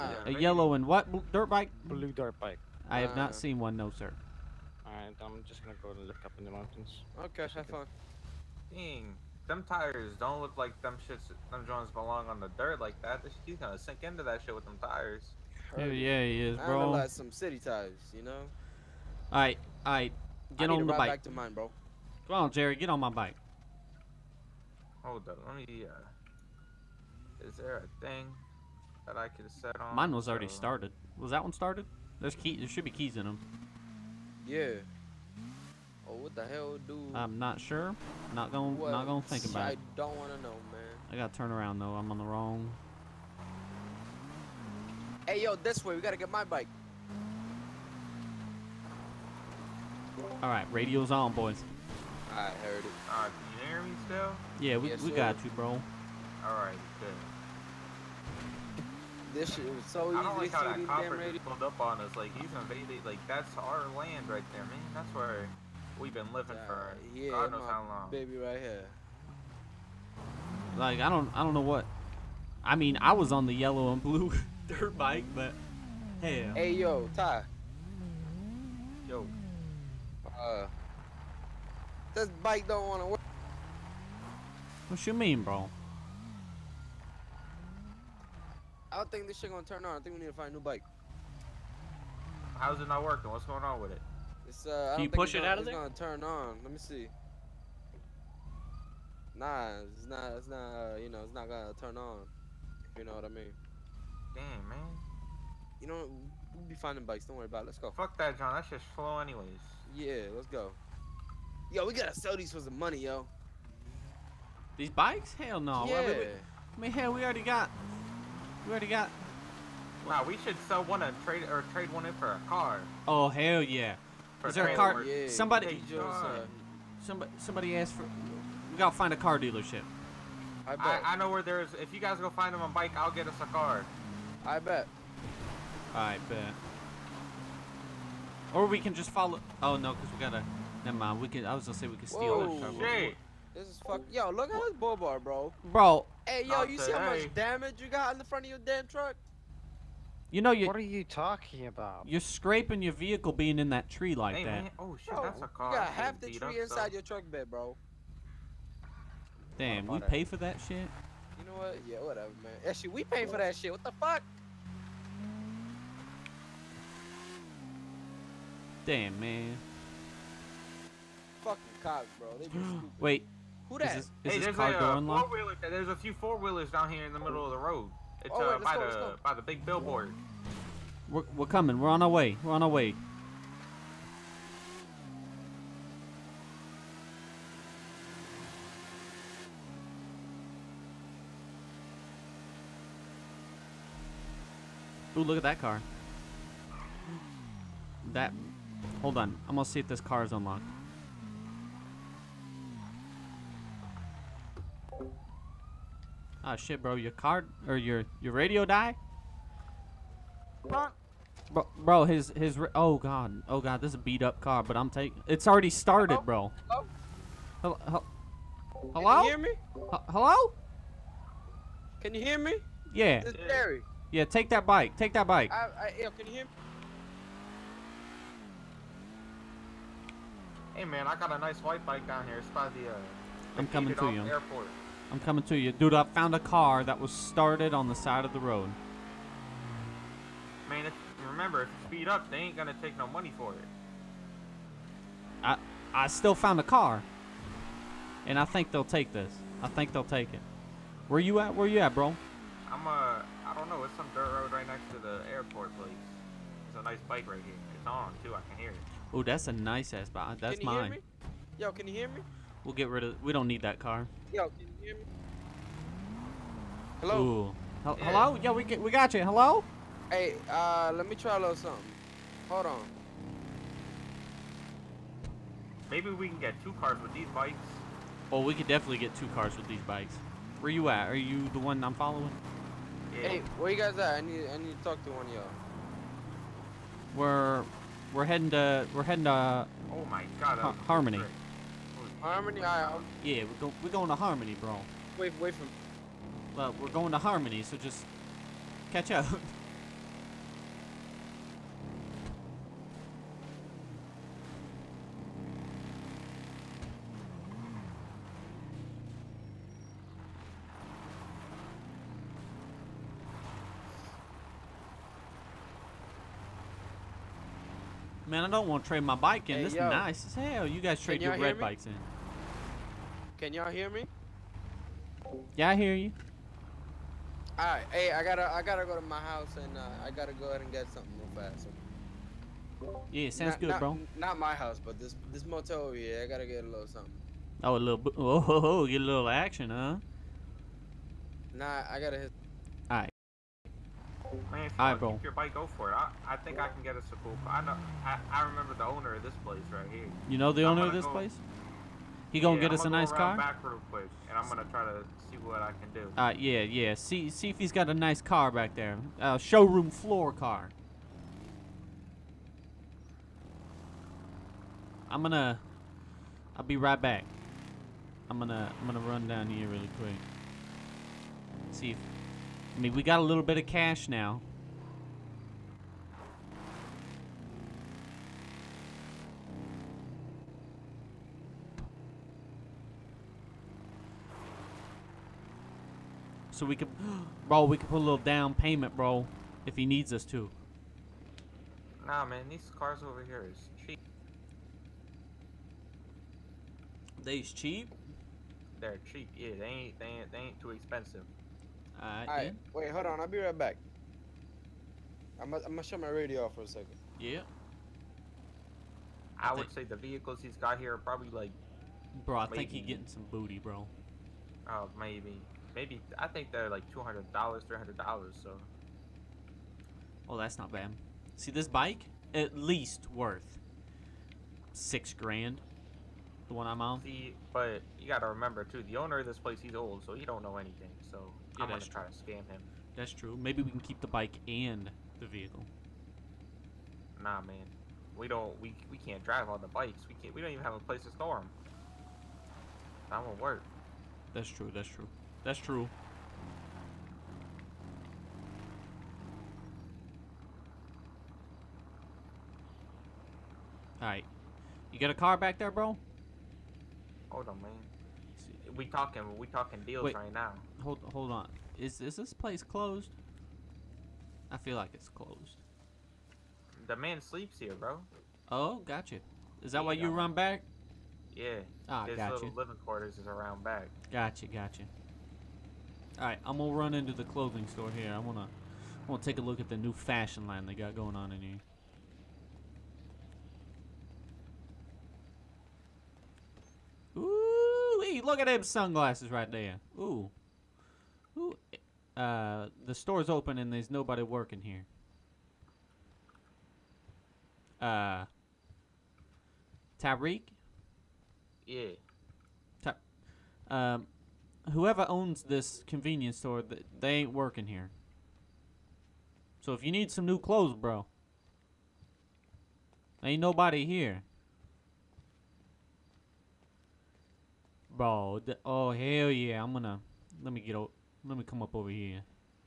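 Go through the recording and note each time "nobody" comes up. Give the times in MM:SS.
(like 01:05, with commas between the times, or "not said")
08:13, 08:33.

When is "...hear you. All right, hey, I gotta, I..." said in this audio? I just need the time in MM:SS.
05:25.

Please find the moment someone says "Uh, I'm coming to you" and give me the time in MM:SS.
03:52.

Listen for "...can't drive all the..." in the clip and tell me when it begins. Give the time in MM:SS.
07:18.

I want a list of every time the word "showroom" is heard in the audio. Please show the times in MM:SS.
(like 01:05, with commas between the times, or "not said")
05:59.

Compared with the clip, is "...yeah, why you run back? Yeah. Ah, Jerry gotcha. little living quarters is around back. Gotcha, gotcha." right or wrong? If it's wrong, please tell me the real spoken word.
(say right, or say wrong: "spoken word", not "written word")
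wrong: "His", not "Jerry".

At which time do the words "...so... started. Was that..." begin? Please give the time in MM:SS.
00:30.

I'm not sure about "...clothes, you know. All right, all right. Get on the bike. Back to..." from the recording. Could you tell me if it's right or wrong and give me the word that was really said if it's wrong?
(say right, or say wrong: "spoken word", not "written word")
wrong: "tires", not "clothes".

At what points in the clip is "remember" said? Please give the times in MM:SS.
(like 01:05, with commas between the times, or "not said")
04:01, 05:48, 07:08.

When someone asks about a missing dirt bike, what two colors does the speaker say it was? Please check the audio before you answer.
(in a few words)
Yellow and blue.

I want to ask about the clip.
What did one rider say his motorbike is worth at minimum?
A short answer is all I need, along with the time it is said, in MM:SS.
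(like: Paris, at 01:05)
6 grand, at 07:04.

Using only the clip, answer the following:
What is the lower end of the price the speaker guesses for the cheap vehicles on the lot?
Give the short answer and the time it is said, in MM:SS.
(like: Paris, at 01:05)
$200, at 06:56.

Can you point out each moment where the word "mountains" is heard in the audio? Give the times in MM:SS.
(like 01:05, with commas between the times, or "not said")
00:06.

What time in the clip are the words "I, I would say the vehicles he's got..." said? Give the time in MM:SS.
06:49.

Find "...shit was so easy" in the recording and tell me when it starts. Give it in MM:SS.
00:59.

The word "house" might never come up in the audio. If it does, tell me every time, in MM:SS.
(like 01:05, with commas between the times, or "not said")
05:29, 05:34.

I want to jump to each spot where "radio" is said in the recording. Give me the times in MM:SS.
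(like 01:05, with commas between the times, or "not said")
00:50, 03:28, 06:46.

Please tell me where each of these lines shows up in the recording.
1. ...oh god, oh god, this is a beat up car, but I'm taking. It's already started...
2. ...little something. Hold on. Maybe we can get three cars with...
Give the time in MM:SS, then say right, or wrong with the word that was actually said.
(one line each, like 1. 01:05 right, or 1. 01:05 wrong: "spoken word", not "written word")
1. 03:32 right
2. 04:31 wrong: "two", not "three".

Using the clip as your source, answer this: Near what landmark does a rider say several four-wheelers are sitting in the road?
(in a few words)
The big billboard.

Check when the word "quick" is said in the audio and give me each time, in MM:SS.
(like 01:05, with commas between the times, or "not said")
05:53, 06:09.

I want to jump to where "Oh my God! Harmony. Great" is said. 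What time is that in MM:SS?
04:49.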